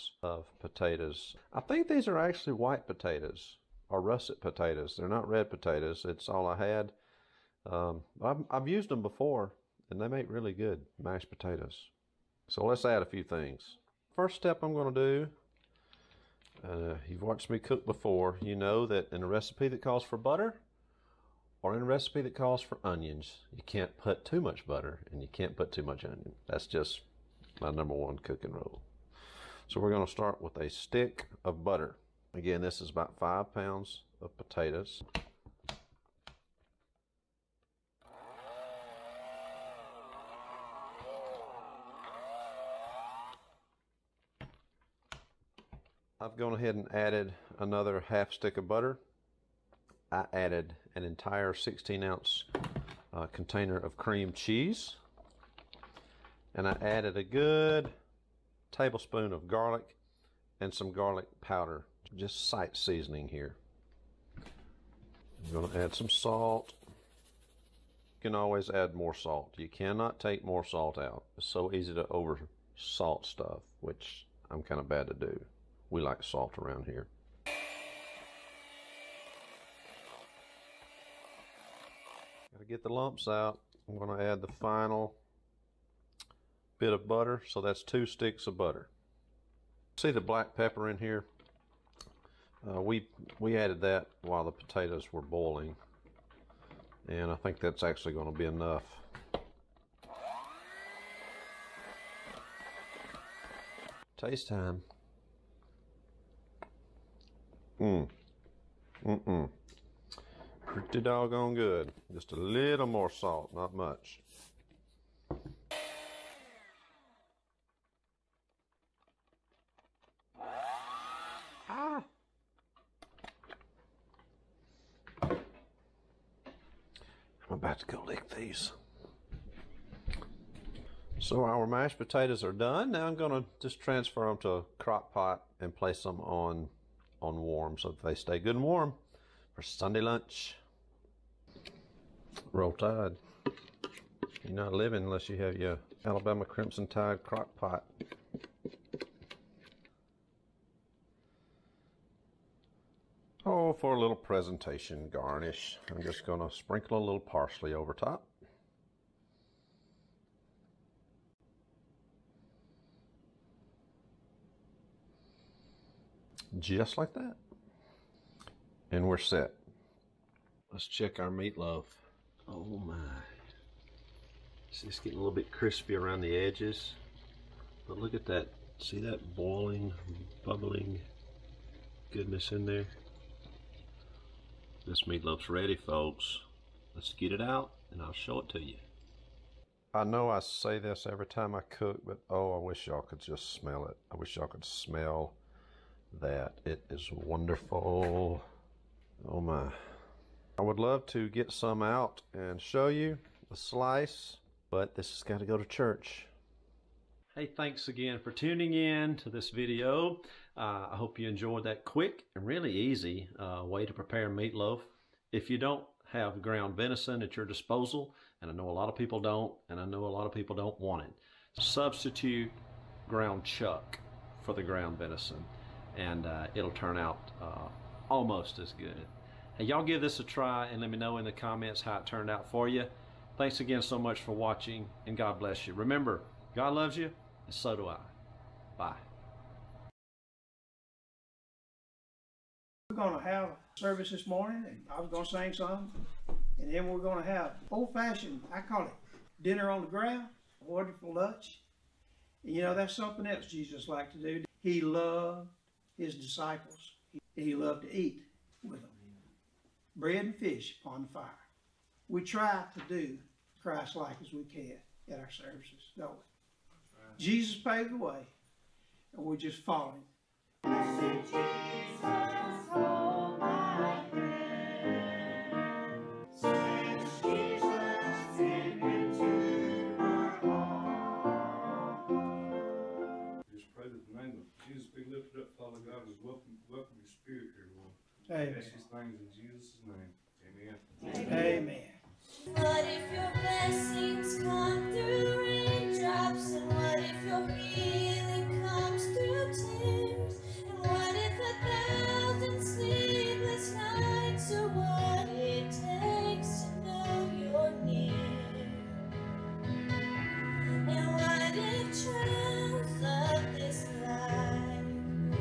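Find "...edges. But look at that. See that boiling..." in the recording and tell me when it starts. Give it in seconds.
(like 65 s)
176 s.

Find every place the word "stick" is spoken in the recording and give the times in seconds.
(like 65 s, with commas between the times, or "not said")
30 s, 48 s, 88 s.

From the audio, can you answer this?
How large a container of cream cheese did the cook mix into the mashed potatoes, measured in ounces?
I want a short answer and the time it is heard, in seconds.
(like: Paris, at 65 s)
16 ounce, at 51 s.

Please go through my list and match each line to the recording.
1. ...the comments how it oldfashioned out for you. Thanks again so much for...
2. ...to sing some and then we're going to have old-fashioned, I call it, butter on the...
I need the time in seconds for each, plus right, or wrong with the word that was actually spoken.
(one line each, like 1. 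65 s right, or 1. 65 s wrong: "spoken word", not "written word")
1. 231 s wrong: "turned", not "oldfashioned"
2. 245 s wrong: "dinner", not "butter".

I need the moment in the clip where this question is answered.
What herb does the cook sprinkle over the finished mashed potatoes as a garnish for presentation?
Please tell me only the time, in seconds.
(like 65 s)
157 s.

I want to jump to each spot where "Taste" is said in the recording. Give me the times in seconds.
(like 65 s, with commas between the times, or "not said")
104 s.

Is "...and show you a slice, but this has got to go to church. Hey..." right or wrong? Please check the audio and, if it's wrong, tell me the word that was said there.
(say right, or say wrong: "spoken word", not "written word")
right.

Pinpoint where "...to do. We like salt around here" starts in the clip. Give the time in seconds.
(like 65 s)
75 s.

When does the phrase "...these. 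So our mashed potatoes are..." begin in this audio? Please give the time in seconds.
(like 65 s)
128 s.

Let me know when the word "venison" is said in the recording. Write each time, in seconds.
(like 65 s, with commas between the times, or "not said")
216 s, 224 s.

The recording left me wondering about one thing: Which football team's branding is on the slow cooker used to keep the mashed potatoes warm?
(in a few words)
Alabama Crimson Tide.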